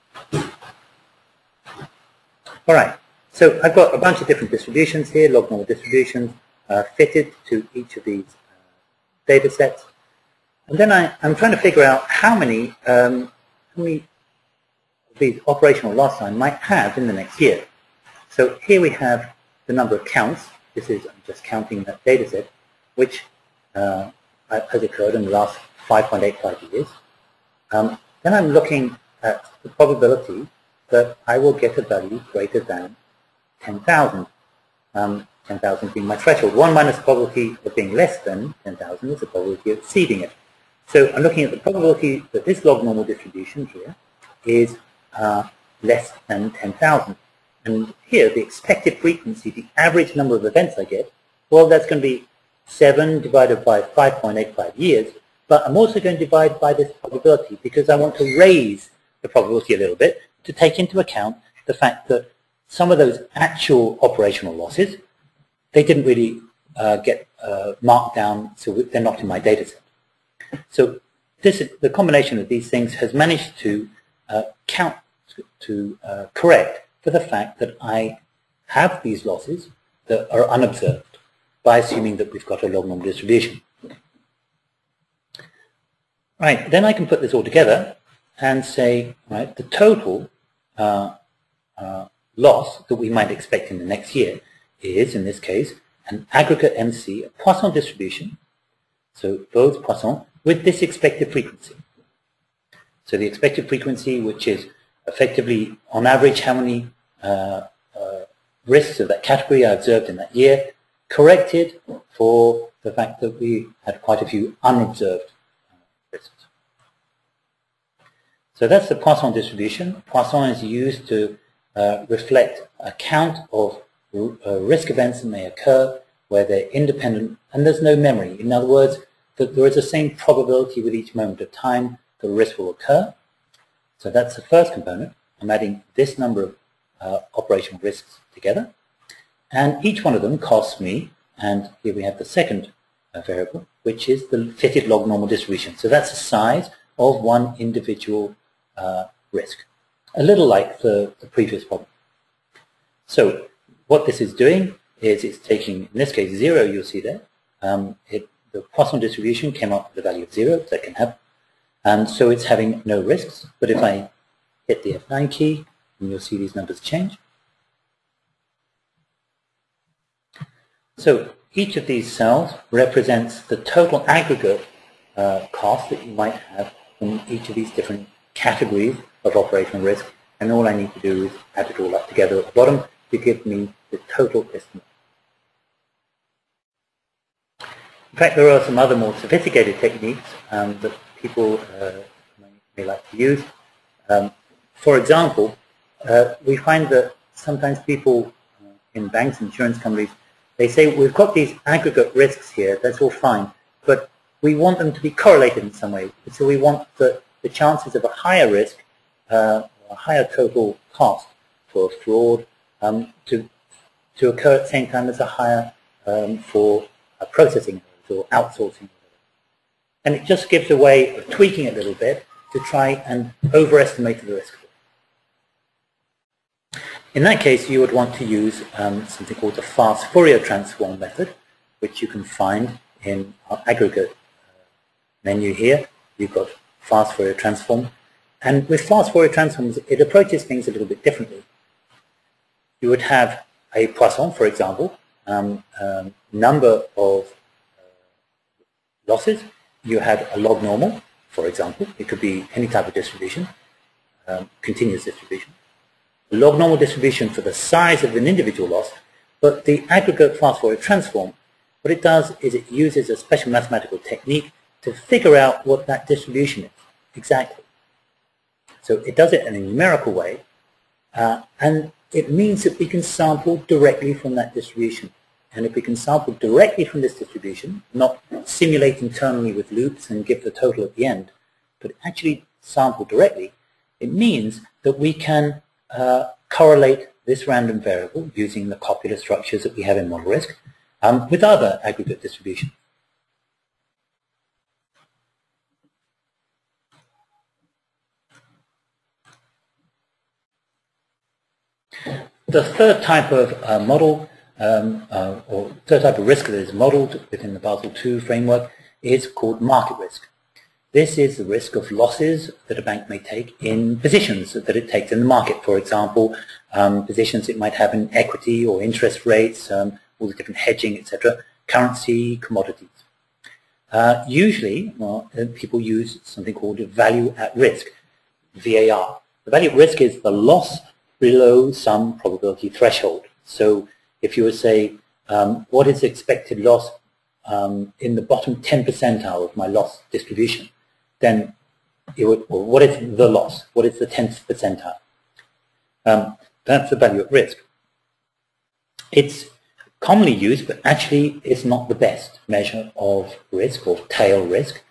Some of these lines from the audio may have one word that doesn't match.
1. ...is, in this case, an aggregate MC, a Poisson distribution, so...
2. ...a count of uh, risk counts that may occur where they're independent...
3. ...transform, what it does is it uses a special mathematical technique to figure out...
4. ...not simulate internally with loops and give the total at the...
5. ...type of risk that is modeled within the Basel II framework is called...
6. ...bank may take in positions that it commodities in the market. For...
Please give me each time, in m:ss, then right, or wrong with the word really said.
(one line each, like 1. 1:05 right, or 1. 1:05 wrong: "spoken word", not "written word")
1. 1:34 right
2. 2:02 wrong: "events", not "counts"
3. 4:20 right
4. 4:37 right
5. 5:06 right
6. 5:12 wrong: "takes", not "commodities".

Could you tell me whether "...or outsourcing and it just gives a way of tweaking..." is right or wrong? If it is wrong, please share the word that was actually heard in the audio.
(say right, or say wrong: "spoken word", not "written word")
right.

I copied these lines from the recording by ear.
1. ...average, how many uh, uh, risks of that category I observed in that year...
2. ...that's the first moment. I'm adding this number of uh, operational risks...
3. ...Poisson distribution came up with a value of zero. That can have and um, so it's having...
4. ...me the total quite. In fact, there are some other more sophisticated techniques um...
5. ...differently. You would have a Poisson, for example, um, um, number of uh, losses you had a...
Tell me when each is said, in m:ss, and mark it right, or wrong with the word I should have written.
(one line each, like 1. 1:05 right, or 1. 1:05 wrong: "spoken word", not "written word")
1. 1:46 right
2. 2:14 wrong: "component", not "moment"
3. 2:38 right
4. 3:03 wrong: "estimate", not "quite"
5. 4:01 right.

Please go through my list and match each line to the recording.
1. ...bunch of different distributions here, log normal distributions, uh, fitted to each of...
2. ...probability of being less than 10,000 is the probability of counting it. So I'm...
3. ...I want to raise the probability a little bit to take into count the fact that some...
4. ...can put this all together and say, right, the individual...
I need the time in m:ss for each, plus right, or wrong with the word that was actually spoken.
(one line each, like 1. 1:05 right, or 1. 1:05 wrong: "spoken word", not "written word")
1. 0:03 right
2. 0:36 wrong: "exceeding", not "counting"
3. 0:57 wrong: "account", not "count"
4. 1:26 wrong: "total", not "individual".